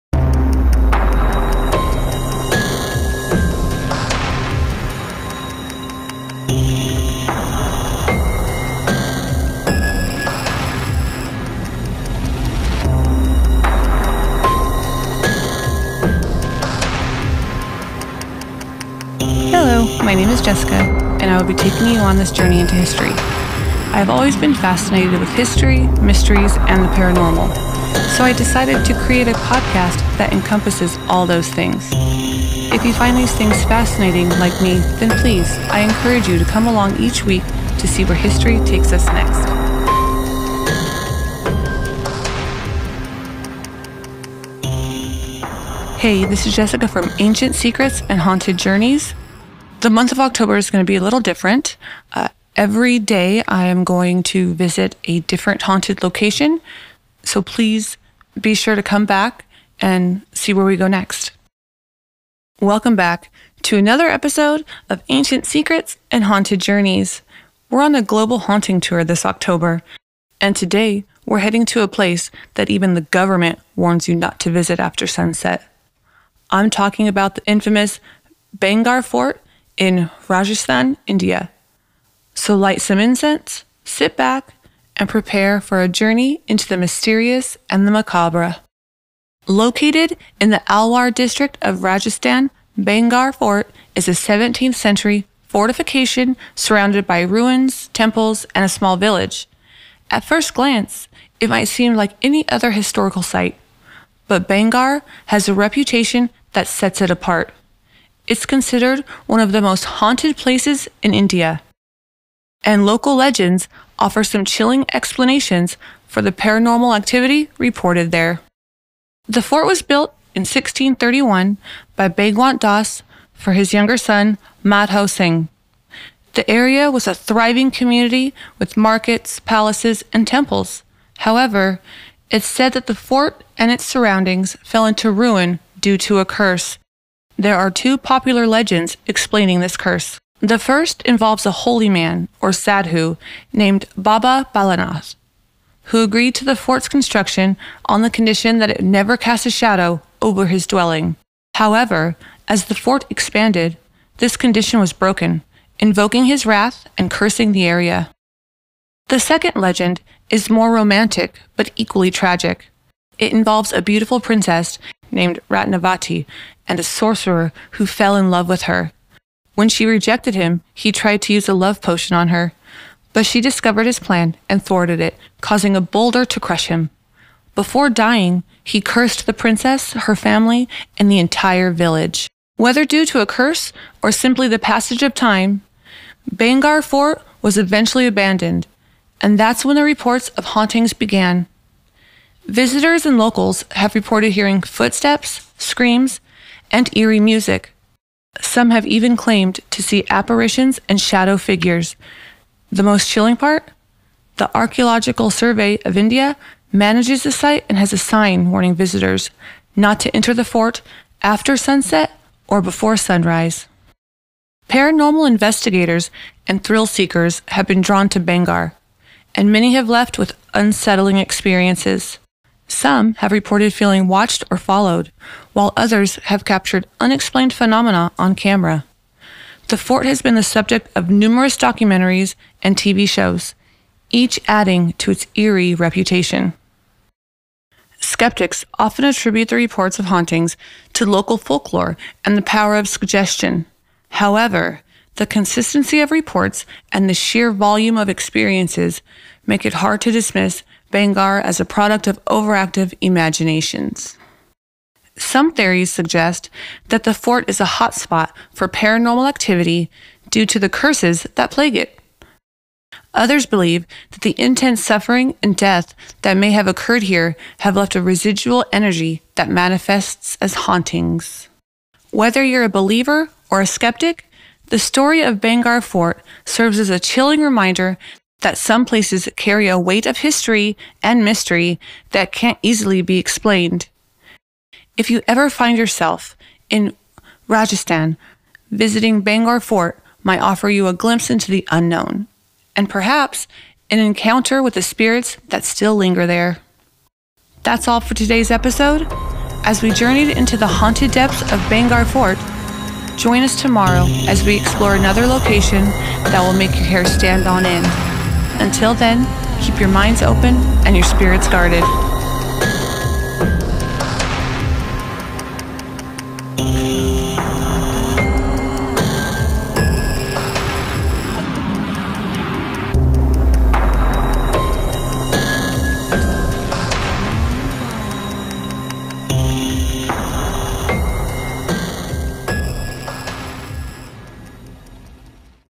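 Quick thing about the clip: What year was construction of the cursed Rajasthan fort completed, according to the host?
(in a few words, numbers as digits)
1631.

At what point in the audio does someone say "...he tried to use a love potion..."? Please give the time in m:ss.
2:50.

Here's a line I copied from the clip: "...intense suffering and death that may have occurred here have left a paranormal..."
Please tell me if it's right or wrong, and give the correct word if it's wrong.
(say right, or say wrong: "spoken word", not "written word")
wrong: "residual", not "paranormal".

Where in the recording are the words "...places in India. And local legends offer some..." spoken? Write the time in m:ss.
1:50.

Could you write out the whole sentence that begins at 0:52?
Uh, every day I am going to visit a different haunted location.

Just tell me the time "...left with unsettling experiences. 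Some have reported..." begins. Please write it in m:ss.
3:39.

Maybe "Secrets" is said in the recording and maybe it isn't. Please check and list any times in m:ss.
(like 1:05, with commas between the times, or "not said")
0:47, 1:05.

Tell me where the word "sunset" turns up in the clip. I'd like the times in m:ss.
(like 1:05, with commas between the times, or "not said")
1:15, 3:31.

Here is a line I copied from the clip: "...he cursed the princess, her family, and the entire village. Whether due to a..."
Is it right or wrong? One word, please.
right.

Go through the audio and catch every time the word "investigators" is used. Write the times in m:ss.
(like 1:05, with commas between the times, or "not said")
3:35.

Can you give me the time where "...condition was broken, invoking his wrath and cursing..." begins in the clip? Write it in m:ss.
2:34.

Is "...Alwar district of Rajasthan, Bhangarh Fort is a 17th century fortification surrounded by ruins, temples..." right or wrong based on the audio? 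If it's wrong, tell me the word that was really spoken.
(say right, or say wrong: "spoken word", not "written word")
right.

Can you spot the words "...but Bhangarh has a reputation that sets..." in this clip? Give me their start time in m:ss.
1:44.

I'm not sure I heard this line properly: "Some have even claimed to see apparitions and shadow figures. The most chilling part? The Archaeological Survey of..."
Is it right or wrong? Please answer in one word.
right.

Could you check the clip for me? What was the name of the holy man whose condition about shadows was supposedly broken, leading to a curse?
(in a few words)
Baba Balanath.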